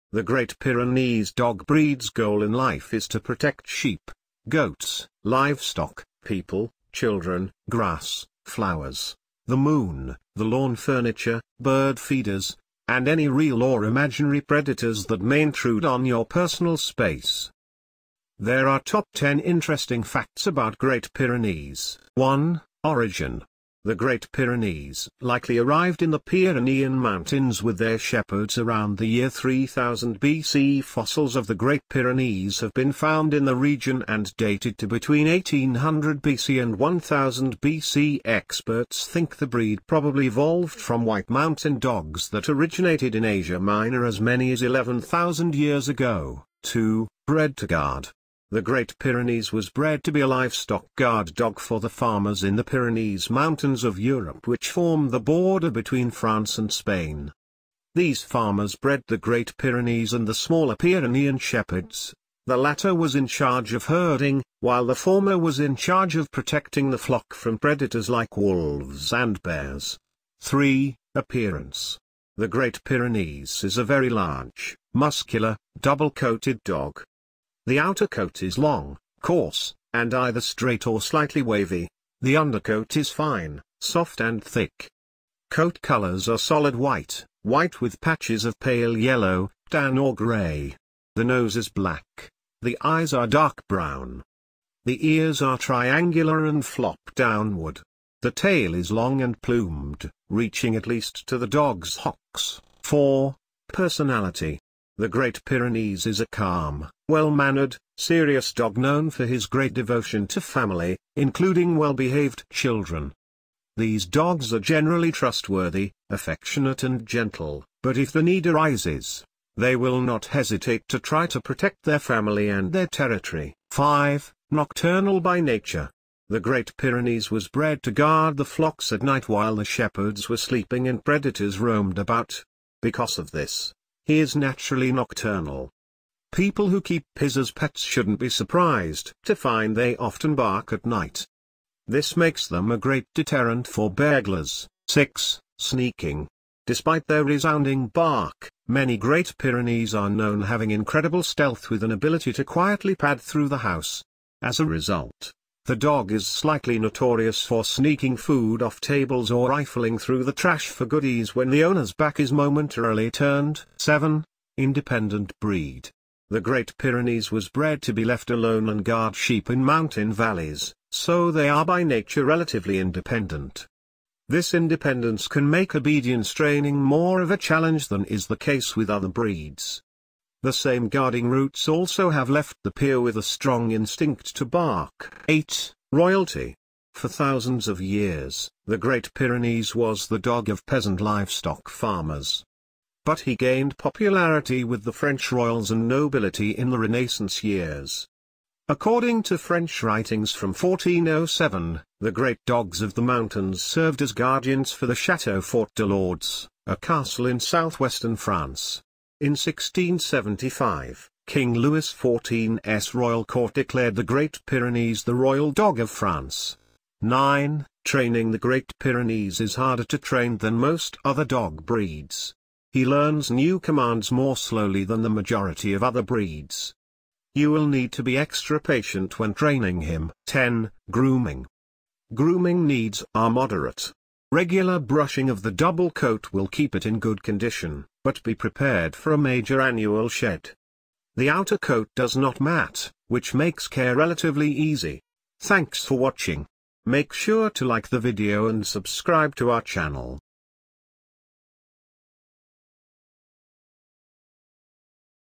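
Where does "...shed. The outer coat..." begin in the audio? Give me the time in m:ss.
4:00.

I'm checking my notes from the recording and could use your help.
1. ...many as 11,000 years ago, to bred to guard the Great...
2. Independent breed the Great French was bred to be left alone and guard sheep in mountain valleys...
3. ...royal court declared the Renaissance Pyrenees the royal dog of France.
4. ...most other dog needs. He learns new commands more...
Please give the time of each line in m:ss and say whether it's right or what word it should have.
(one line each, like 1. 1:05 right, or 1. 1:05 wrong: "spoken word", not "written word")
1. 0:44 right
2. 2:44 wrong: "Pyrenees", not "French"
3. 3:32 wrong: "Great", not "Renaissance"
4. 3:40 wrong: "breeds", not "needs".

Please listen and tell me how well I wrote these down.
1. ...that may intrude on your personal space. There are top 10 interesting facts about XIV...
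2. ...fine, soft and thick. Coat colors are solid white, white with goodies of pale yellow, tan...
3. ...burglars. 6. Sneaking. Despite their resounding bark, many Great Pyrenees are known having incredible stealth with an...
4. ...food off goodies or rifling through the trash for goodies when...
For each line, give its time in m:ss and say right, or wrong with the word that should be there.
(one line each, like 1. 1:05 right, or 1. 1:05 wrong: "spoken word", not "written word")
1. 0:15 wrong: "Great", not "XIV"
2. 1:23 wrong: "patches", not "goodies"
3. 2:23 right
4. 2:38 wrong: "tables", not "goodies".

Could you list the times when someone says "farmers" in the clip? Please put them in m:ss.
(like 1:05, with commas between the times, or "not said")
0:51, 0:58, 3:11.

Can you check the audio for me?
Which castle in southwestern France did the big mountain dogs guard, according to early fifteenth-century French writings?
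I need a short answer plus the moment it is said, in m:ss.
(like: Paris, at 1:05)
Chateau Fort de Lourdes, at 3:24.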